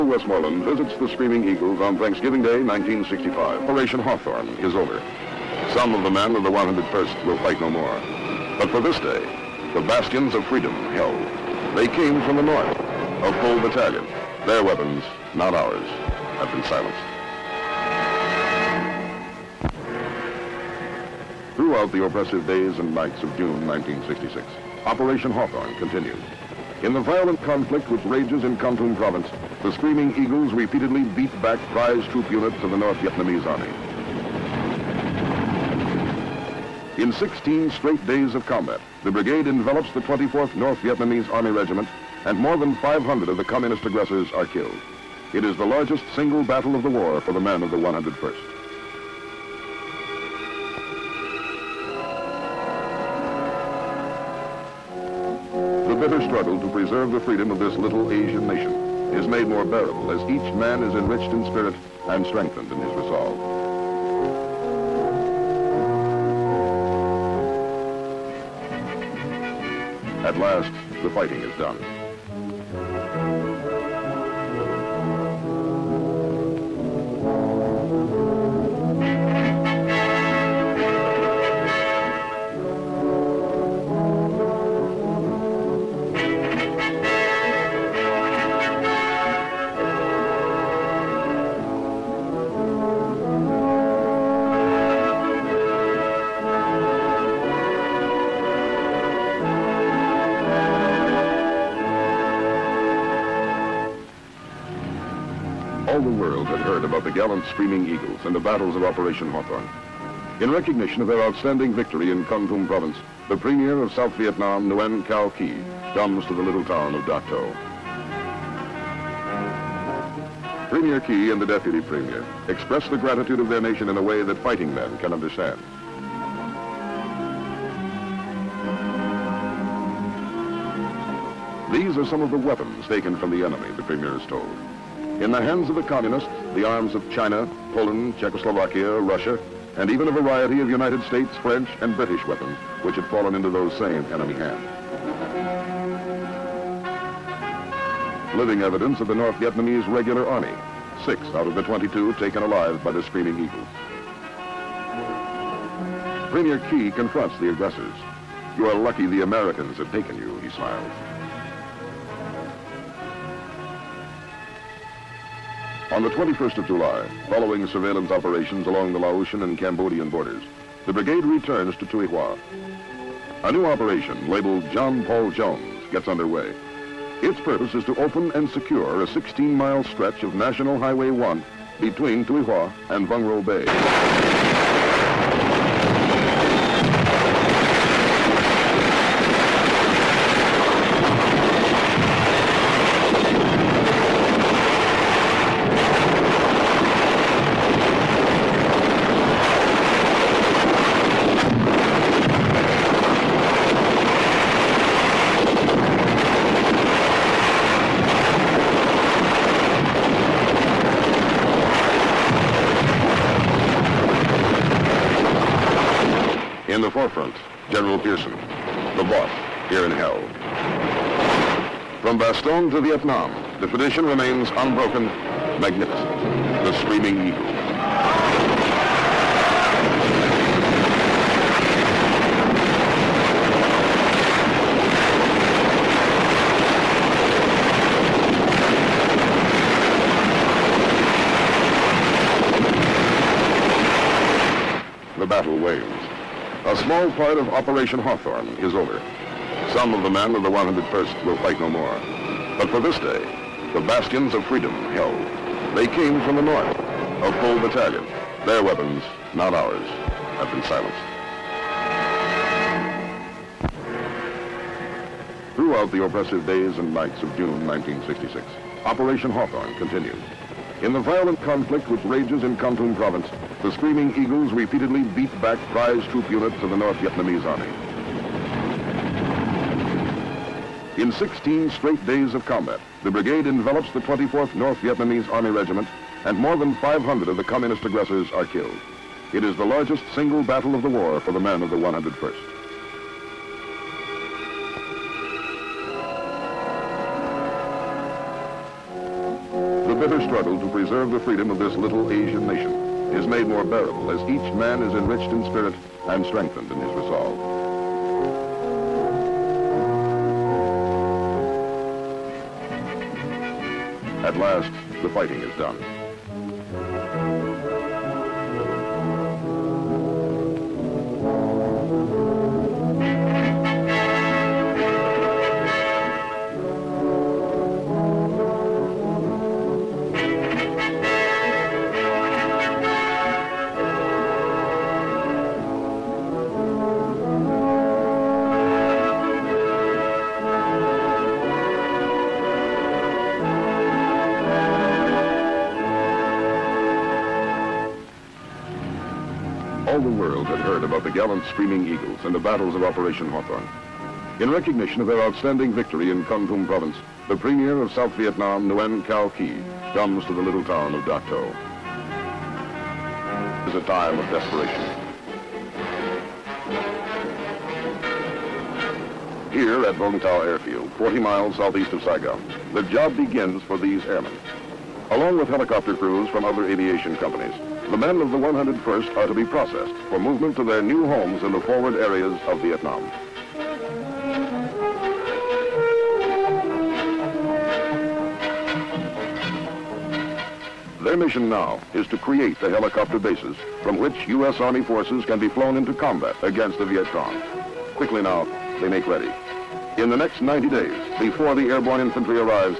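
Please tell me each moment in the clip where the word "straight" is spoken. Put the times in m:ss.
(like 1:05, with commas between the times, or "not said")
0:37, 4:41.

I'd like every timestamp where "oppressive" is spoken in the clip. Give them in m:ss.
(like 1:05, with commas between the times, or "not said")
0:22, 4:26.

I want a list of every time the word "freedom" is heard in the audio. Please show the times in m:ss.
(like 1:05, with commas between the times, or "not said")
0:10, 0:57, 4:14, 5:01.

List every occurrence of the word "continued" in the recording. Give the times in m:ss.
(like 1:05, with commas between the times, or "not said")
0:25, 4:29.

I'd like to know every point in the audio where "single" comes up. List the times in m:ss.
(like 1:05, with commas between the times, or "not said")
0:46, 4:50.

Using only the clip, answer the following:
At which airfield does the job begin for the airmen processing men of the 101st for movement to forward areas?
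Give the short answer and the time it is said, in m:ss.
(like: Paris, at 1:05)
Vung Tau Airfield, at 6:09.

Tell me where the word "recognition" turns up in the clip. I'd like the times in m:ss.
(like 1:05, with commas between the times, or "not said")
1:50, 5:54.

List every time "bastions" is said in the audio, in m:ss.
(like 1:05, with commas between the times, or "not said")
0:09, 4:13.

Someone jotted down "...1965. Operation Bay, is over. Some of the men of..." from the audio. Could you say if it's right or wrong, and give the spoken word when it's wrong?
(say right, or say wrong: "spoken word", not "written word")
wrong: "Hawthorne", not "Bay".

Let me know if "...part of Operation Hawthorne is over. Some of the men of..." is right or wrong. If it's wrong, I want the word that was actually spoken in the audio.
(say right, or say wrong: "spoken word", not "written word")
right.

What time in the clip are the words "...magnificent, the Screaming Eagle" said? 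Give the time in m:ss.
3:45.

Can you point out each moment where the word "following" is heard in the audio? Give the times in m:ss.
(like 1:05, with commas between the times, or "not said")
2:47.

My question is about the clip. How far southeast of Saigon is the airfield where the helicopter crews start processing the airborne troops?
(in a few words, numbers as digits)
40 miles.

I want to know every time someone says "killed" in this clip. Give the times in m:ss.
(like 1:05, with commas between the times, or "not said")
0:44, 4:48.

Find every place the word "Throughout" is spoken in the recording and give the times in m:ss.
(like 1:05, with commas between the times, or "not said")
0:21, 4:25.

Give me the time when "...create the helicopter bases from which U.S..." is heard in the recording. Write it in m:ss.
6:32.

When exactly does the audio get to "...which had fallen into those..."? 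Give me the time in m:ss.
2:22.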